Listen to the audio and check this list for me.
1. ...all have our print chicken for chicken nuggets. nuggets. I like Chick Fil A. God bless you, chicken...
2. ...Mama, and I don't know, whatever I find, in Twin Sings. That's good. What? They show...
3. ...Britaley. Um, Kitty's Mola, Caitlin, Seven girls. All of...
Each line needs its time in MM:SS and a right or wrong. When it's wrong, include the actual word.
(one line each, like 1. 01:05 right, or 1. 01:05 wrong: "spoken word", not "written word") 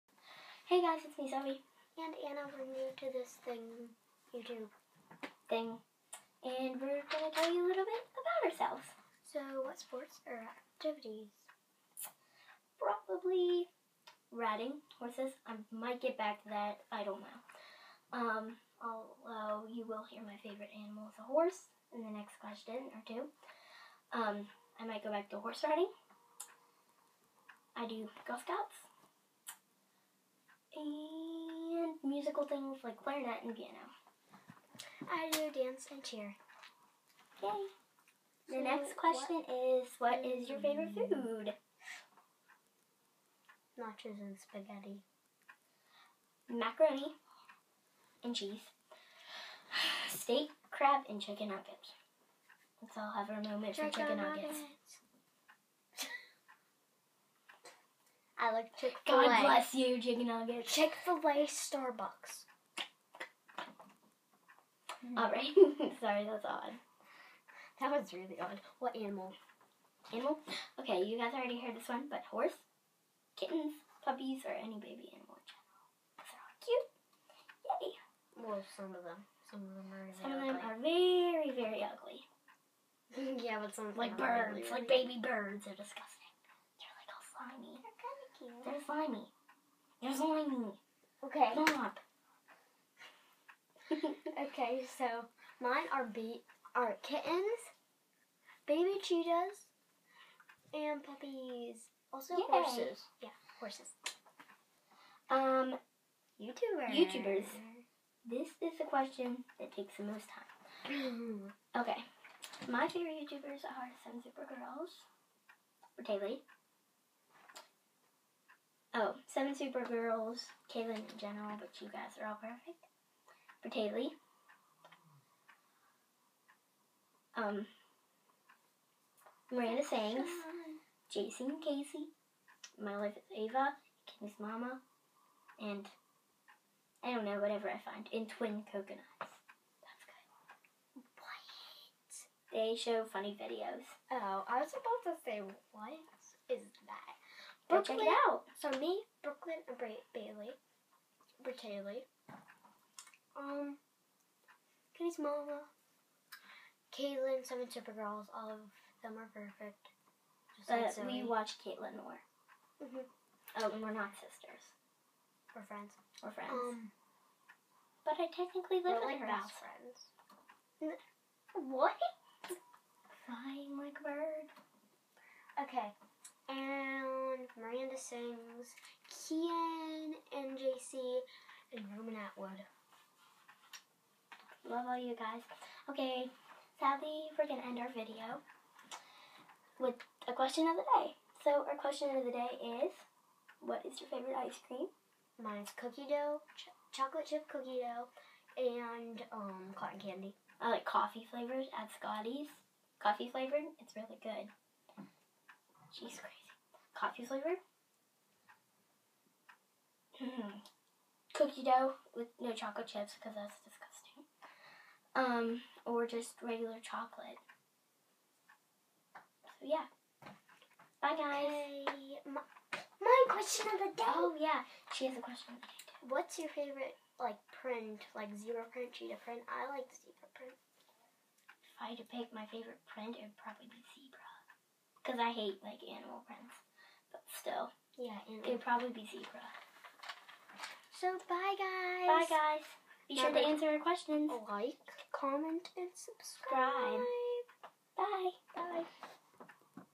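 1. 00:52 wrong: "moment", not "print"
2. 02:14 wrong: "Coconuts", not "Sings"
3. 02:31 right.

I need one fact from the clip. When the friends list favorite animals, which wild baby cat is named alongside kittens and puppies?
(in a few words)
Baby cheetahs.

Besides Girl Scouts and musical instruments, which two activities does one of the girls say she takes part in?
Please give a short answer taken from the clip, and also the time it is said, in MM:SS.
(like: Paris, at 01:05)
Dance and cheer, at 00:35.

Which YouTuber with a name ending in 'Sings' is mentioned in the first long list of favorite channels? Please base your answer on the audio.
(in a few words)
Miranda Sings.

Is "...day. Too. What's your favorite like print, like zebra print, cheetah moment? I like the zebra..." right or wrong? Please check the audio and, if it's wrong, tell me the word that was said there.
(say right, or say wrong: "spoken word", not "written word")
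wrong: "print", not "moment".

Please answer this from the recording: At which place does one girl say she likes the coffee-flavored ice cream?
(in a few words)
Scotty's.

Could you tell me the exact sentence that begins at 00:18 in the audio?
Um, although you will hear my favorite animal is a horse in the next question or two.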